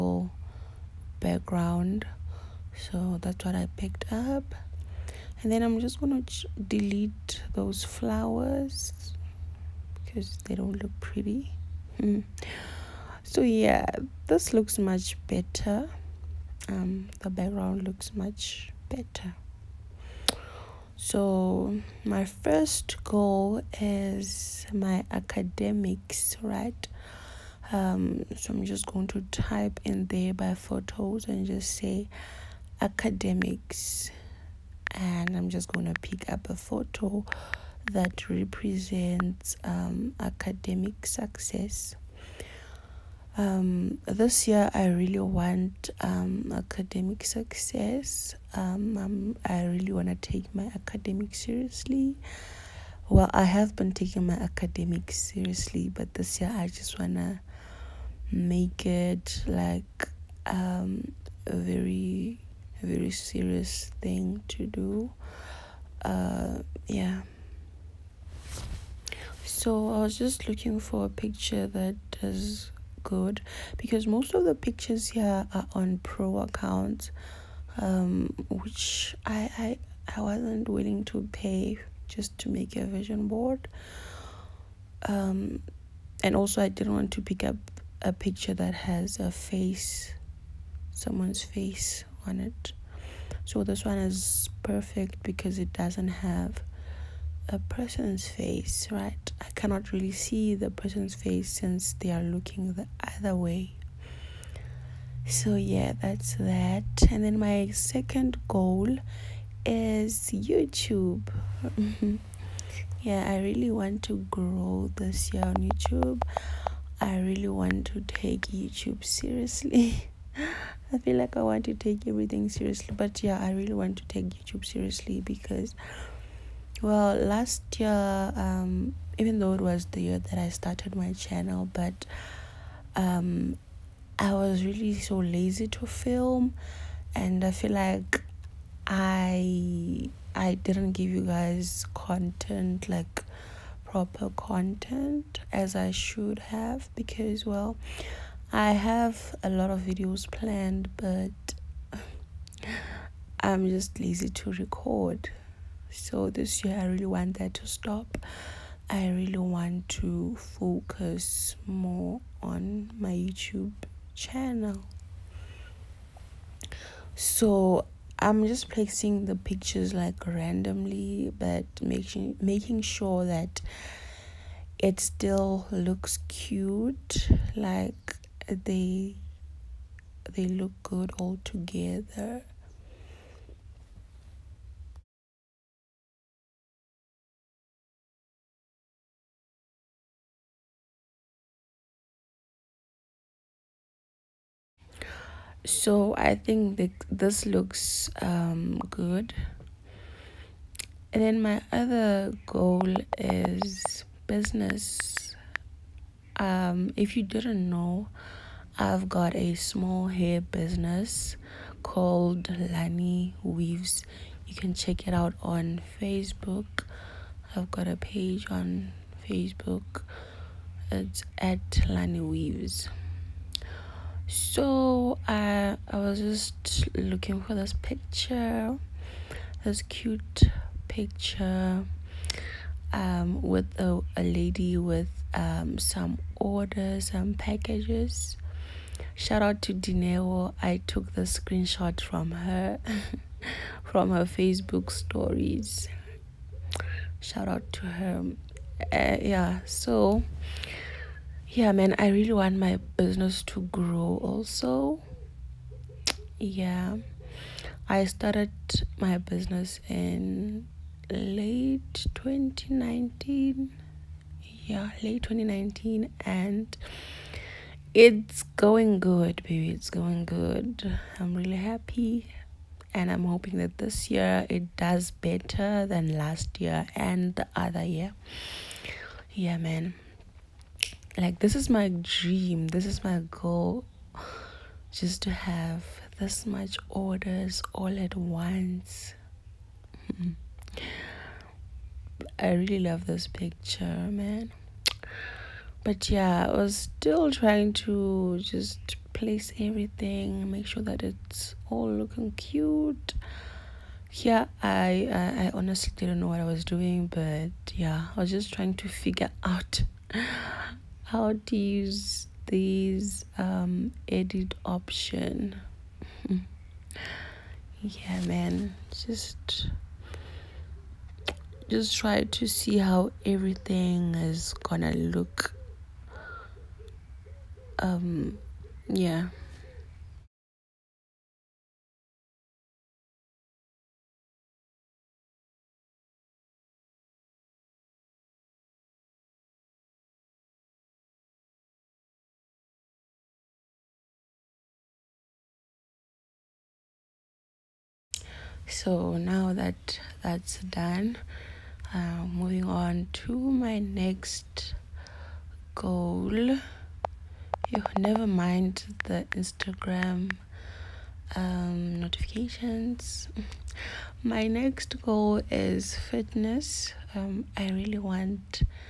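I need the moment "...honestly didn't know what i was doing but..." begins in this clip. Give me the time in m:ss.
5:05.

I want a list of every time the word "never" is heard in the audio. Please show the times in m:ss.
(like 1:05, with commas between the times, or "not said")
5:57.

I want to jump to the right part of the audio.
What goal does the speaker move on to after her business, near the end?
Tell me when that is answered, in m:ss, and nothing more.
6:05.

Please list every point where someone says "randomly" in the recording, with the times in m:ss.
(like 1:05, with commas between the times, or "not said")
2:50.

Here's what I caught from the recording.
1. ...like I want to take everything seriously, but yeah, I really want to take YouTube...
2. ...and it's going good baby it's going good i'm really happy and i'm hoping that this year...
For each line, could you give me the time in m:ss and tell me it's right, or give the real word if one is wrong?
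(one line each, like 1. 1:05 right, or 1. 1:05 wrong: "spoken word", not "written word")
1. 2:01 right
2. 4:26 right.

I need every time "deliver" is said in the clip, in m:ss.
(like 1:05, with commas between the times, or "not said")
not said.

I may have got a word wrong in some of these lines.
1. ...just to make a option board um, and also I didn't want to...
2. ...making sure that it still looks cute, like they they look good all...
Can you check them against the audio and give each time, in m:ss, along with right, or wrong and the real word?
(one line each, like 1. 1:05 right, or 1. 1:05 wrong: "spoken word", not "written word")
1. 1:22 wrong: "vision", not "option"
2. 2:52 right.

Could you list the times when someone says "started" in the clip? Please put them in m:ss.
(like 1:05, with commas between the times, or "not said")
2:10, 4:18.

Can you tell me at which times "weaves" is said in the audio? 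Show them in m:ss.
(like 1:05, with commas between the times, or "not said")
3:33, 3:42.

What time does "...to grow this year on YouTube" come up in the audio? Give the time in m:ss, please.
1:54.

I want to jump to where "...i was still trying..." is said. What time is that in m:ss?
4:56.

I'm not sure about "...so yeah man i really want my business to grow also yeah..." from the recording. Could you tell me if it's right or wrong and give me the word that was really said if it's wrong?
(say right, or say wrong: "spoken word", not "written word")
right.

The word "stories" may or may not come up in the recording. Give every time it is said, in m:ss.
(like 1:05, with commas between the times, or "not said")
4:04.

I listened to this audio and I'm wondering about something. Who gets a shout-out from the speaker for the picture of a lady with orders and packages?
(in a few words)
Dineo.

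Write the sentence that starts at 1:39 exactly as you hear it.
I cannot really see the person's face since they are looking the other way.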